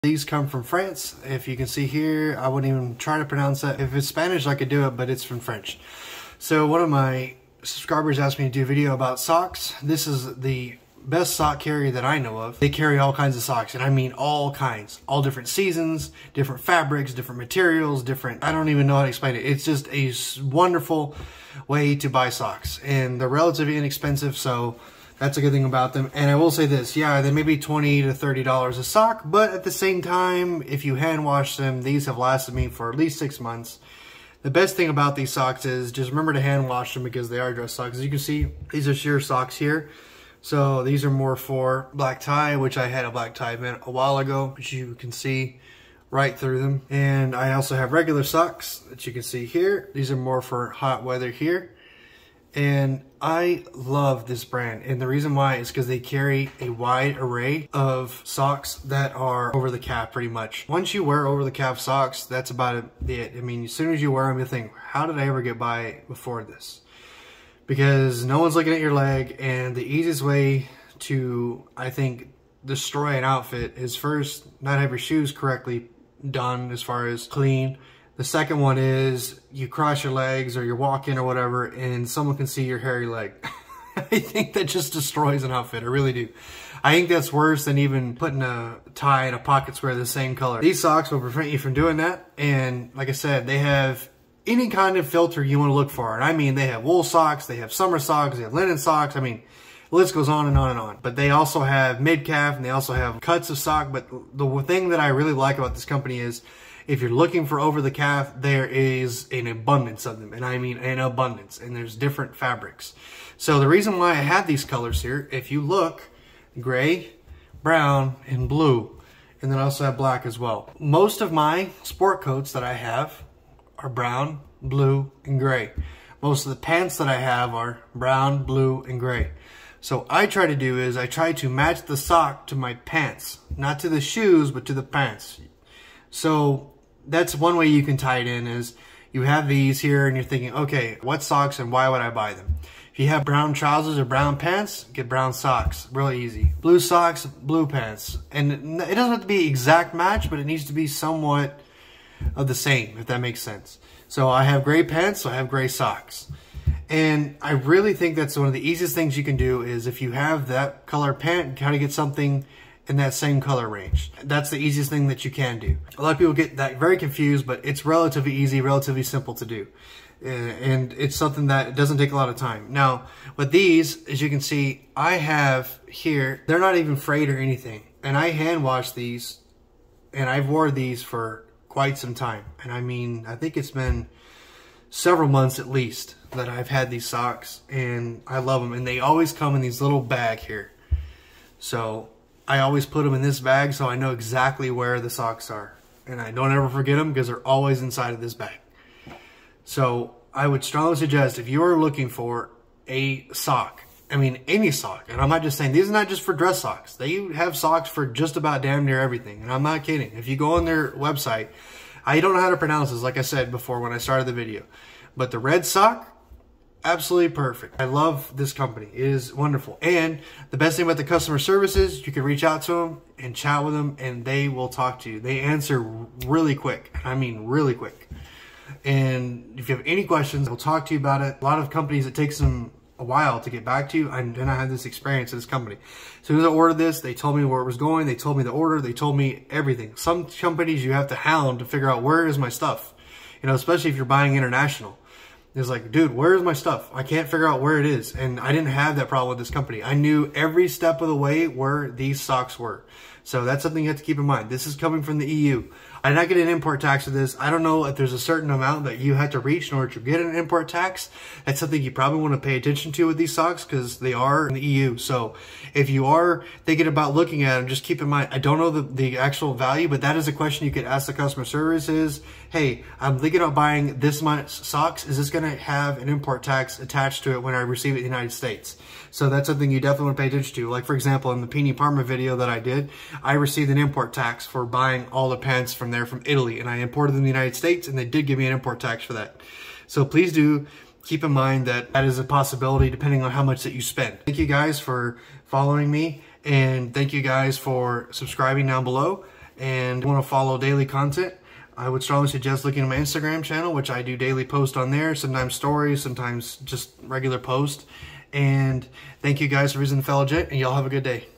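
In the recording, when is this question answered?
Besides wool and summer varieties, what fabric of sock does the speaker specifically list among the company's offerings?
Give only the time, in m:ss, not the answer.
1:38.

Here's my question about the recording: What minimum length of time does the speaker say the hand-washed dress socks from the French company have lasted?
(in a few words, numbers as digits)
6 months.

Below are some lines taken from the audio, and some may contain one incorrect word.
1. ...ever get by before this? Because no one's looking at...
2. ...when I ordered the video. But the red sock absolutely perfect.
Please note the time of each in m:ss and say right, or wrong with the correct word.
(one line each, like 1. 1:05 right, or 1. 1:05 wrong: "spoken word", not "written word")
1. 1:05 right
2. 3:33 wrong: "started", not "ordered".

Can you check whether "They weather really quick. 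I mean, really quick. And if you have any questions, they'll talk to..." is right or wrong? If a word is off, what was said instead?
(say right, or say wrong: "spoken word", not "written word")
wrong: "answer", not "weather".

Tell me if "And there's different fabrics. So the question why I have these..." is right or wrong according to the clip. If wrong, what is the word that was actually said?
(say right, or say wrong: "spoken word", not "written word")
wrong: "reason", not "question".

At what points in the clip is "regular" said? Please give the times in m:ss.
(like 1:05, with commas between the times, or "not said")
0:47, 5:07.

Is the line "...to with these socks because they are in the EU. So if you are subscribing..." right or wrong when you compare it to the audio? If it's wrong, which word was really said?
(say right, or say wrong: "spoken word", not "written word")
wrong: "thinking", not "subscribing".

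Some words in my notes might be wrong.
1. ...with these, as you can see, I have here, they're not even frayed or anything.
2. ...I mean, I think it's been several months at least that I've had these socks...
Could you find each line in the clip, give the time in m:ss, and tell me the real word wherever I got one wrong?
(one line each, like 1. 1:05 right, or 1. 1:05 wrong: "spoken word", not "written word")
1. 2:53 right
2. 3:02 right.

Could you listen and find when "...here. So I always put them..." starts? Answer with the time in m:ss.
3:10.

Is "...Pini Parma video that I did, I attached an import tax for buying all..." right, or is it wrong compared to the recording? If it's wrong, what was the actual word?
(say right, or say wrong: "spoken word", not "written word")
wrong: "received", not "attached".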